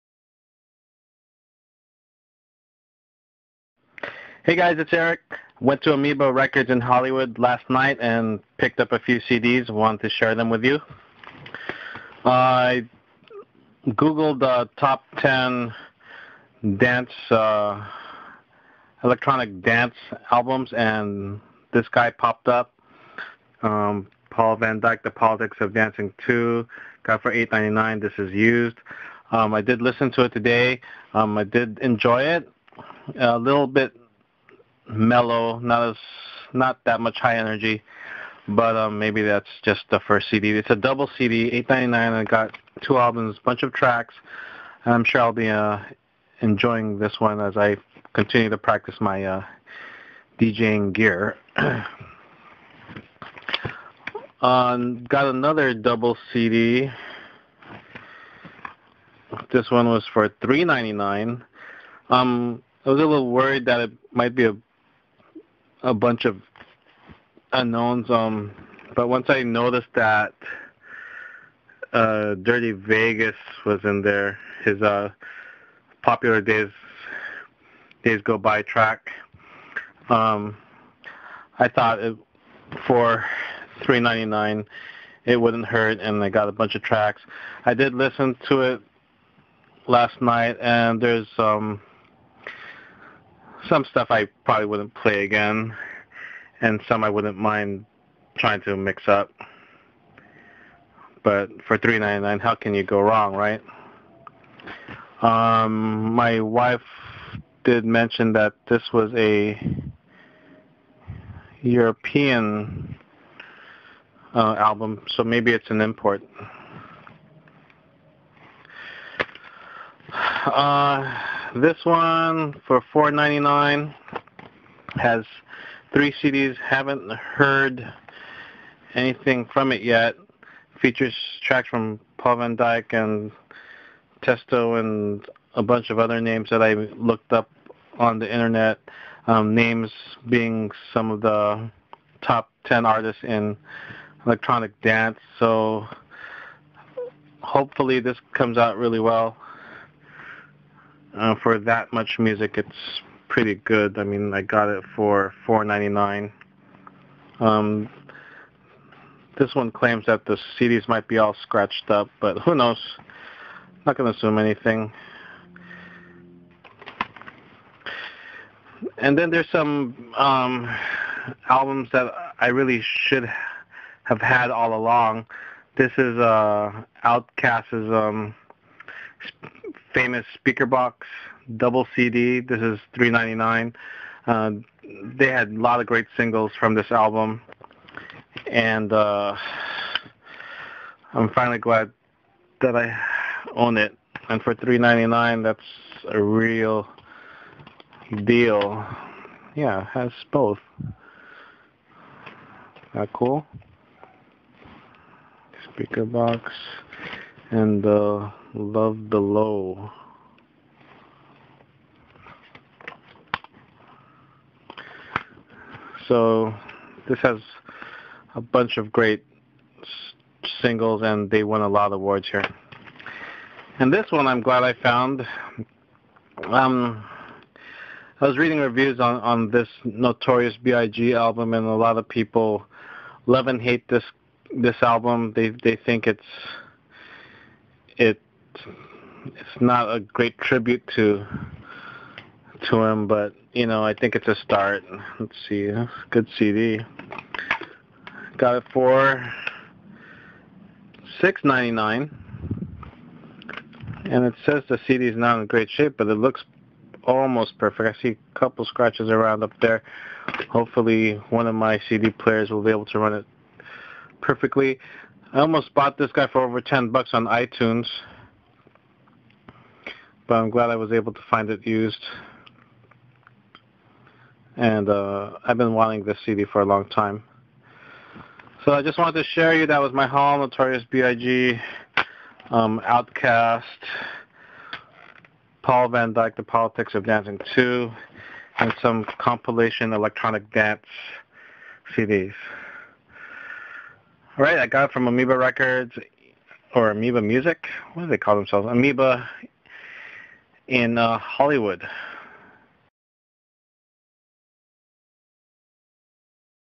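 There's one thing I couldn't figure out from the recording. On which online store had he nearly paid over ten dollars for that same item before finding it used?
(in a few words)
iTunes.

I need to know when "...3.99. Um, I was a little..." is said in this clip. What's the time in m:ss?
1:00.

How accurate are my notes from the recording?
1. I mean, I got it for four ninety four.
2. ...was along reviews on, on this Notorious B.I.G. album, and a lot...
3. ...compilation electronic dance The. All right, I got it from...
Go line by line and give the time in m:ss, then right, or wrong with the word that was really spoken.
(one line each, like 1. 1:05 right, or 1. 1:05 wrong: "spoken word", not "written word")
1. 2:33 wrong: "nine", not "four"
2. 3:48 wrong: "reading", not "along"
3. 4:49 wrong: "CDs", not "The".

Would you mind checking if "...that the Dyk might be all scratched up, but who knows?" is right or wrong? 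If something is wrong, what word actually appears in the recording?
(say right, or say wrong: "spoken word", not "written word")
wrong: "CDs", not "Dyk".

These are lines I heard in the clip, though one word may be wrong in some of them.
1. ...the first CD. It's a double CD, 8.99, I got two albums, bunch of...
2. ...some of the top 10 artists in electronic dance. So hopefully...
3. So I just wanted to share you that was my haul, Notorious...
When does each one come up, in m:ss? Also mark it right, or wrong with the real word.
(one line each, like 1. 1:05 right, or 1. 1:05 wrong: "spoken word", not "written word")
1. 0:39 right
2. 2:20 right
3. 4:38 right.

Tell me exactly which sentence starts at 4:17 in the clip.
I see a couple scratches around up there.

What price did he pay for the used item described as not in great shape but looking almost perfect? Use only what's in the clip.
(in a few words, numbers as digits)
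$6.99.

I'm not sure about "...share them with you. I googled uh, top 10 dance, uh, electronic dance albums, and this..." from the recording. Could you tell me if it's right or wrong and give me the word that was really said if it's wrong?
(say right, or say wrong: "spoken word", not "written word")
right.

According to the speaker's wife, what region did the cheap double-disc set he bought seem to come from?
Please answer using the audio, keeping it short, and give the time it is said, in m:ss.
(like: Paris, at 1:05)
European, at 1:51.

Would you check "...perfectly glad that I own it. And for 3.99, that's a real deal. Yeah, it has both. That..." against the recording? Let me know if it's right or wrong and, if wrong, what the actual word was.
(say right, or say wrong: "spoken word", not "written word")
wrong: "finally", not "perfectly".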